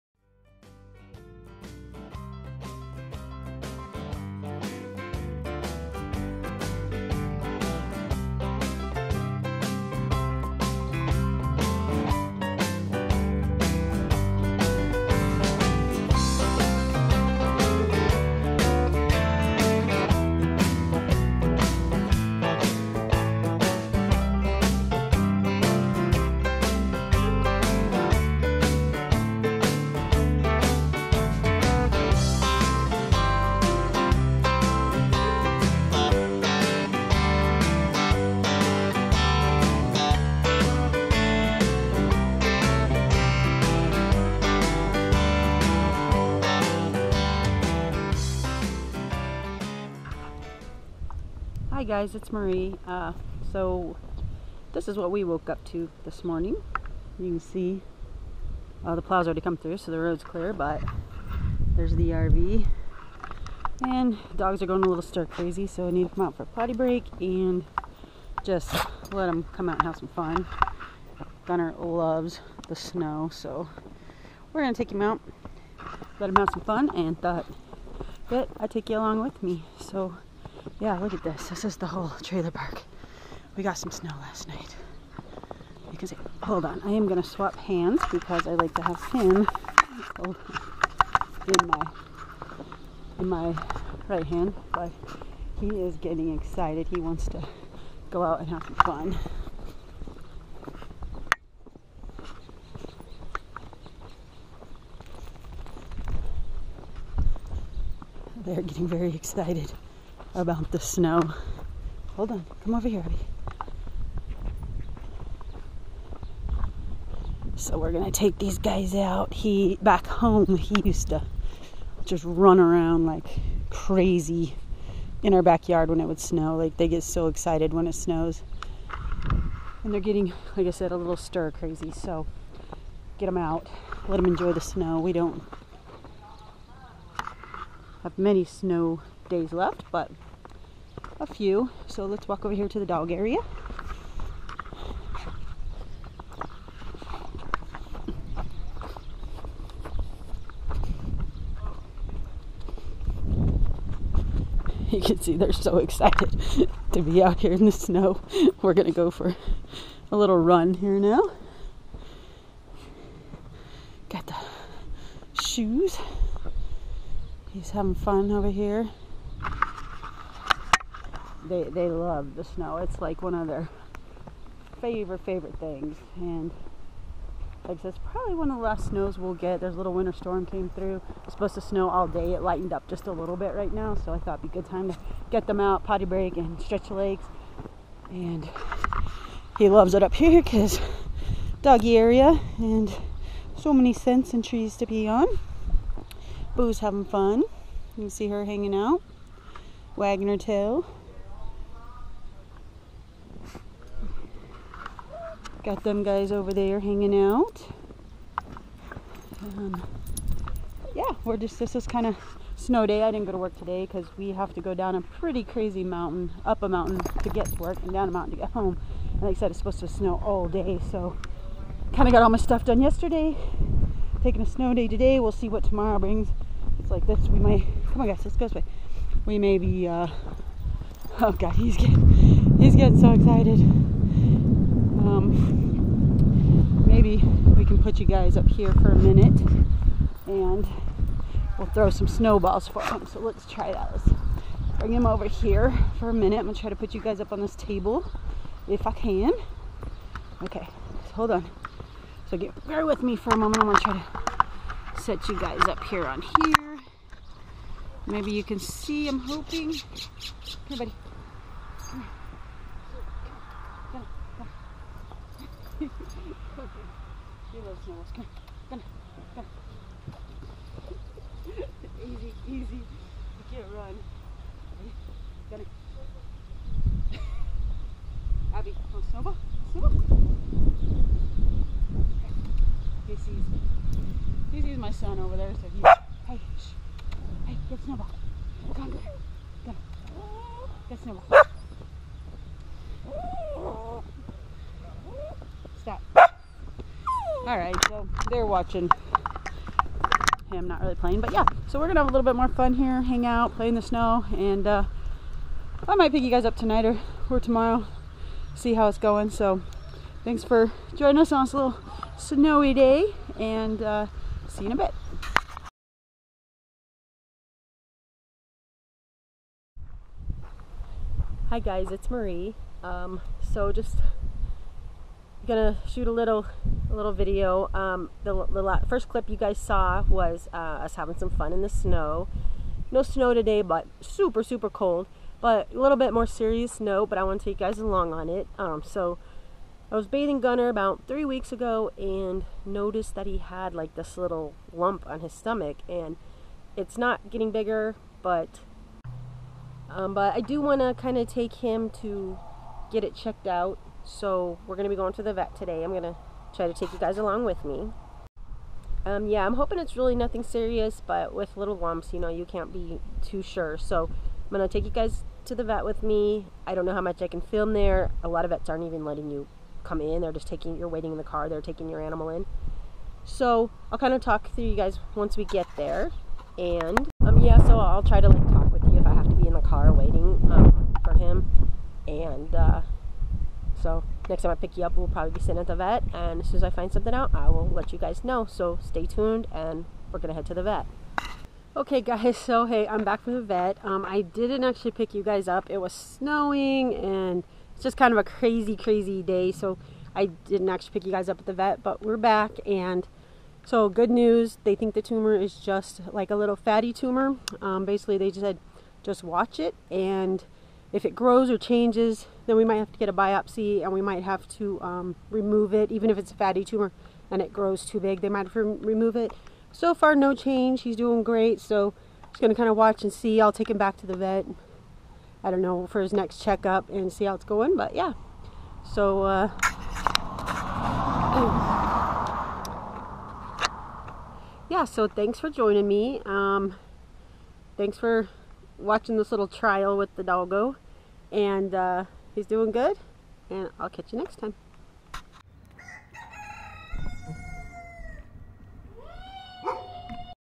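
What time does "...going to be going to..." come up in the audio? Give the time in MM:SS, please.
05:54.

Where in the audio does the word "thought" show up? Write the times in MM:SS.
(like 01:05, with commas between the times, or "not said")
01:17, 03:04.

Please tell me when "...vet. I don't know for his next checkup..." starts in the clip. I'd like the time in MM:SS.
07:04.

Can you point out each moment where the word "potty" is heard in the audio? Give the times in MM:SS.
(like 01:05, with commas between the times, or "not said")
01:06, 03:05.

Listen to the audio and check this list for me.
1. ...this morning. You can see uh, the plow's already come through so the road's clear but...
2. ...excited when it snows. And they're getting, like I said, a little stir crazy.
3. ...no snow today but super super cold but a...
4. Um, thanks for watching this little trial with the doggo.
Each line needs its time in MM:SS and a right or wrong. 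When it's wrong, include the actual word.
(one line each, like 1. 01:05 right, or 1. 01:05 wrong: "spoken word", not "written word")
1. 00:56 right
2. 02:07 right
3. 05:32 right
4. 07:16 right.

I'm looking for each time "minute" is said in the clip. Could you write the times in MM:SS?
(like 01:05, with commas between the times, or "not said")
03:58, 04:06.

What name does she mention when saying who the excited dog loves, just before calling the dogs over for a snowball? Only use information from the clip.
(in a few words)
Norris.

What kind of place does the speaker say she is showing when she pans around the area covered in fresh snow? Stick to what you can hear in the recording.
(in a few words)
trailer park.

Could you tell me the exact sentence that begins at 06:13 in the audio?
So I'll kind of talk through you guys once we get there.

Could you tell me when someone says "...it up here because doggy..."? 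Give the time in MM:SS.
03:09.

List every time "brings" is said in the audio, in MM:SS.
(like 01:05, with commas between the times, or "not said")
03:45, 04:04.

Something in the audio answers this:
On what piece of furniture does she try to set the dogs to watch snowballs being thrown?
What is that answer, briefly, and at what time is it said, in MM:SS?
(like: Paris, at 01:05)
table, at 04:07.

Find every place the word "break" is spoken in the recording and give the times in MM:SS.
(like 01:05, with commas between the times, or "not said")
01:06, 03:06.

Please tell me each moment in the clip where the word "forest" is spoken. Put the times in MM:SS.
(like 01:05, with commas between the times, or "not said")
not said.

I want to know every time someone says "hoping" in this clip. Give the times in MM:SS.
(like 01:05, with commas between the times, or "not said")
04:19, 05:59.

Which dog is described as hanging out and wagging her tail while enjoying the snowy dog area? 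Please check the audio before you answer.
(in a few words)
Boo.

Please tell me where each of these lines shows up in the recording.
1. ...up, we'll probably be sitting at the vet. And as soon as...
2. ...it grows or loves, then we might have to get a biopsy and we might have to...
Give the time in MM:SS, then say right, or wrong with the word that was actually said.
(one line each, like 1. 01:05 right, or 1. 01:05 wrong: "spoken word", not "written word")
1. 06:24 right
2. 06:51 wrong: "changes", not "loves".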